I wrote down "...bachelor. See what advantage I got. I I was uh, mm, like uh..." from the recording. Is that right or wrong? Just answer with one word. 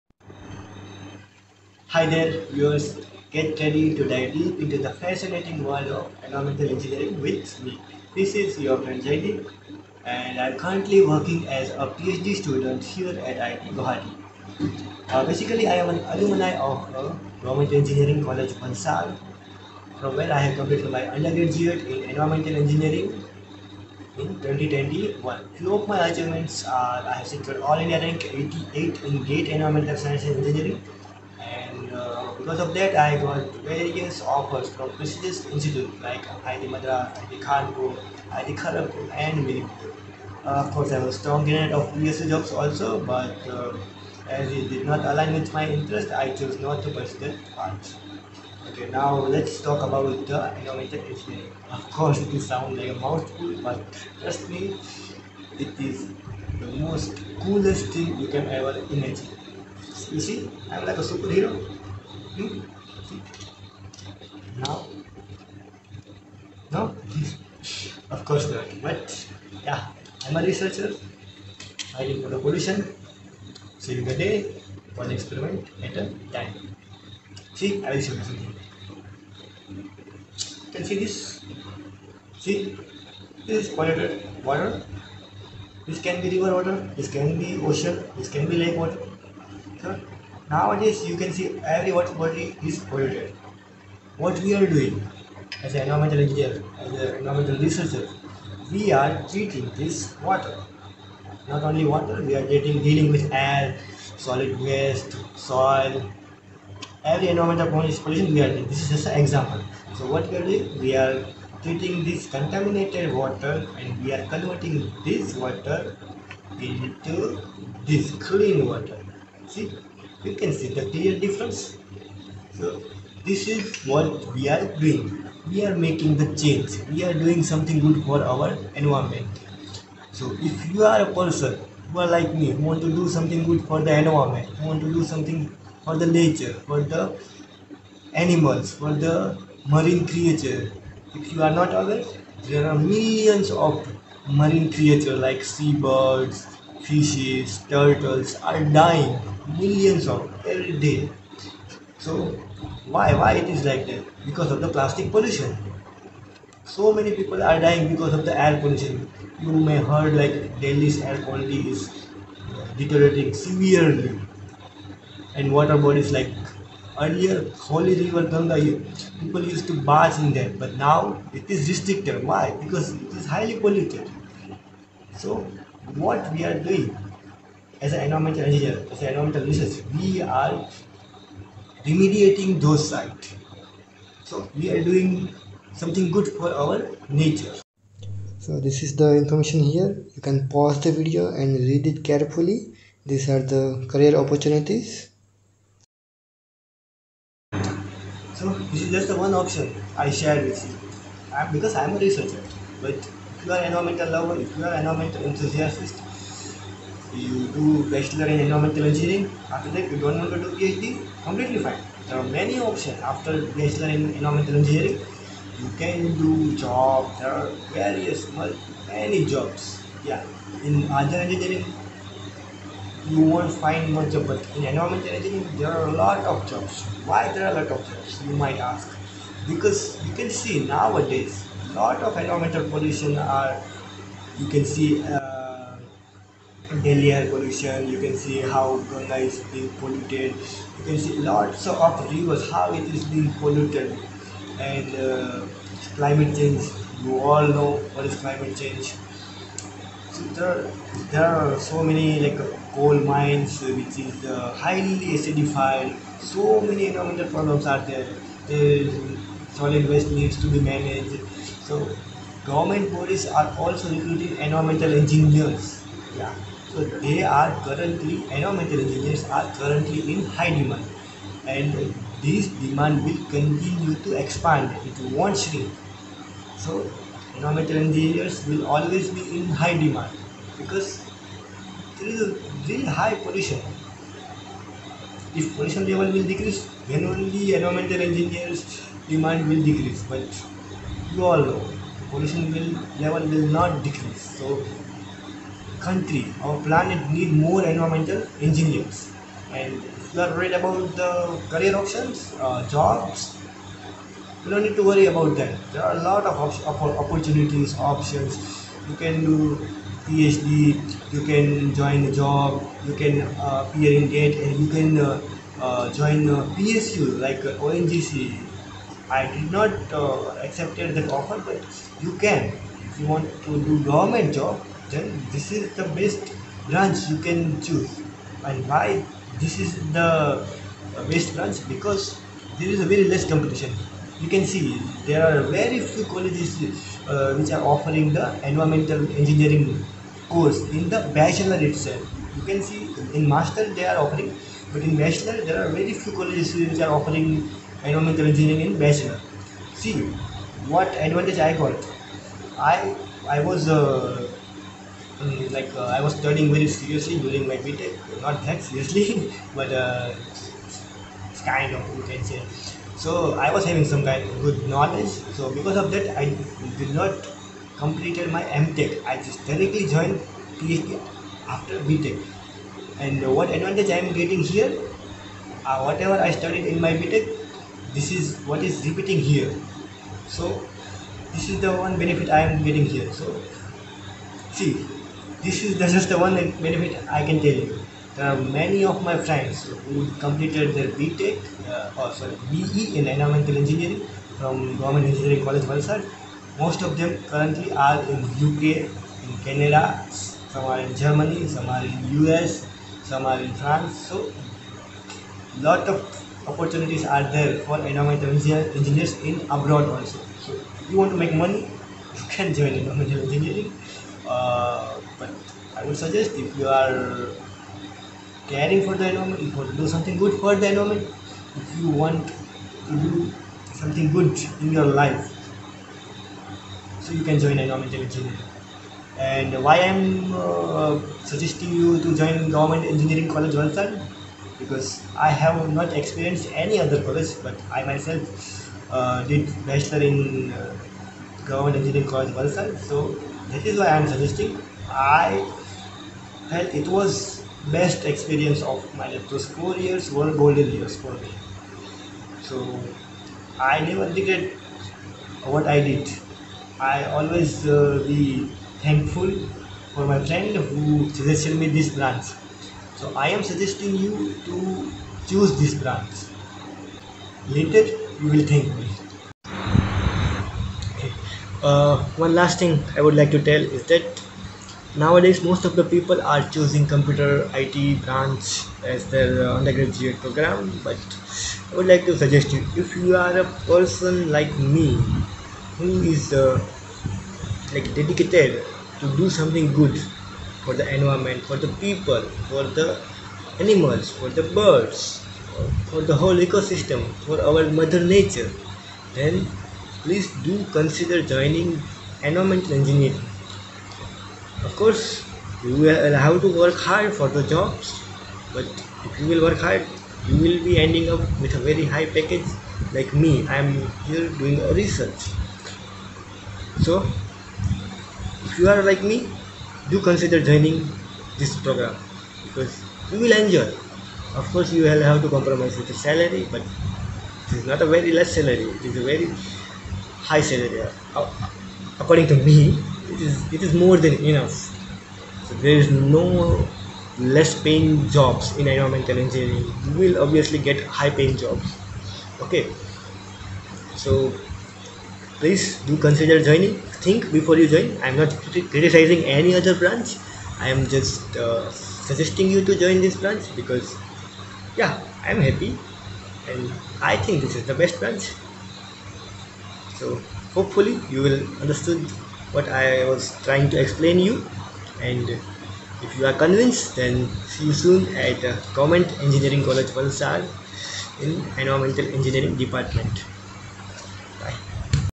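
right.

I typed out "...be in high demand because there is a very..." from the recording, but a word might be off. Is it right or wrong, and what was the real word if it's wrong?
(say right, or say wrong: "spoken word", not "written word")
right.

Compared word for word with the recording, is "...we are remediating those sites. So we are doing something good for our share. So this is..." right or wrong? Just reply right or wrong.
wrong.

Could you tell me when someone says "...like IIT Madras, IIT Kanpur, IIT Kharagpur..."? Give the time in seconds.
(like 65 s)
36 s.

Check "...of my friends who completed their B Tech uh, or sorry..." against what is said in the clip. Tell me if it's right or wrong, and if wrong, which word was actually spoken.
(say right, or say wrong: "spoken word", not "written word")
right.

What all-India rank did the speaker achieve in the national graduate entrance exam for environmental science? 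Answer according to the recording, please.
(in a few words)
88.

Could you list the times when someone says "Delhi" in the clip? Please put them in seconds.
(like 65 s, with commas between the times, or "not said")
160 s, 236 s.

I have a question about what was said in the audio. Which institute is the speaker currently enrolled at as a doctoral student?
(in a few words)
IIT Guwahati.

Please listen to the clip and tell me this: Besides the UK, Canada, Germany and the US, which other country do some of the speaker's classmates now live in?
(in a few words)
France.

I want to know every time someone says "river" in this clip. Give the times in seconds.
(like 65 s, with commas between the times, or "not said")
86 s, 168 s, 242 s.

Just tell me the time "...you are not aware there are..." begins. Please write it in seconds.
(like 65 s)
141 s.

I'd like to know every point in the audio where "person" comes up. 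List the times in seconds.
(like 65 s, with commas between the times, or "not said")
131 s, 483 s.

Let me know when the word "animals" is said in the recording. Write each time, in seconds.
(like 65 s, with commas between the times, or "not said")
138 s, 493 s.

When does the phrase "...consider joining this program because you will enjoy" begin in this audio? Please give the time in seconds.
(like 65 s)
520 s.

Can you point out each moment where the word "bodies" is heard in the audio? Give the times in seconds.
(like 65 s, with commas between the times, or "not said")
165 s, 262 s.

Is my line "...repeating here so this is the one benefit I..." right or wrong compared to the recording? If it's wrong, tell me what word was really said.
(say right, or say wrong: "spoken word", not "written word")
right.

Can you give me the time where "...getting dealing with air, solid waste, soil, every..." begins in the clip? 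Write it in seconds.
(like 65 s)
102 s.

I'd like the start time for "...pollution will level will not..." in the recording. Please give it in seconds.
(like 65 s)
292 s.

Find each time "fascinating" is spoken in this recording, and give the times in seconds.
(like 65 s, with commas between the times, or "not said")
4 s.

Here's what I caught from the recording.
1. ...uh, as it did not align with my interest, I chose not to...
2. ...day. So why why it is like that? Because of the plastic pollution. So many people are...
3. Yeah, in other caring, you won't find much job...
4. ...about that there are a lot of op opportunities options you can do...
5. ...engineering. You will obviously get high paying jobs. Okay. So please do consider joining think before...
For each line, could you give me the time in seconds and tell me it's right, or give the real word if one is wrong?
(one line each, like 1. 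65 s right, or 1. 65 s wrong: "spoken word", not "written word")
1. 43 s right
2. 150 s right
3. 220 s wrong: "engineering", not "caring"
4. 305 s right
5. 539 s right.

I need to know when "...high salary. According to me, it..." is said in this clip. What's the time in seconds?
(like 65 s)
530 s.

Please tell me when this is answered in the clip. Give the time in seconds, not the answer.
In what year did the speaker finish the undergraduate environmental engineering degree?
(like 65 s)
24 s.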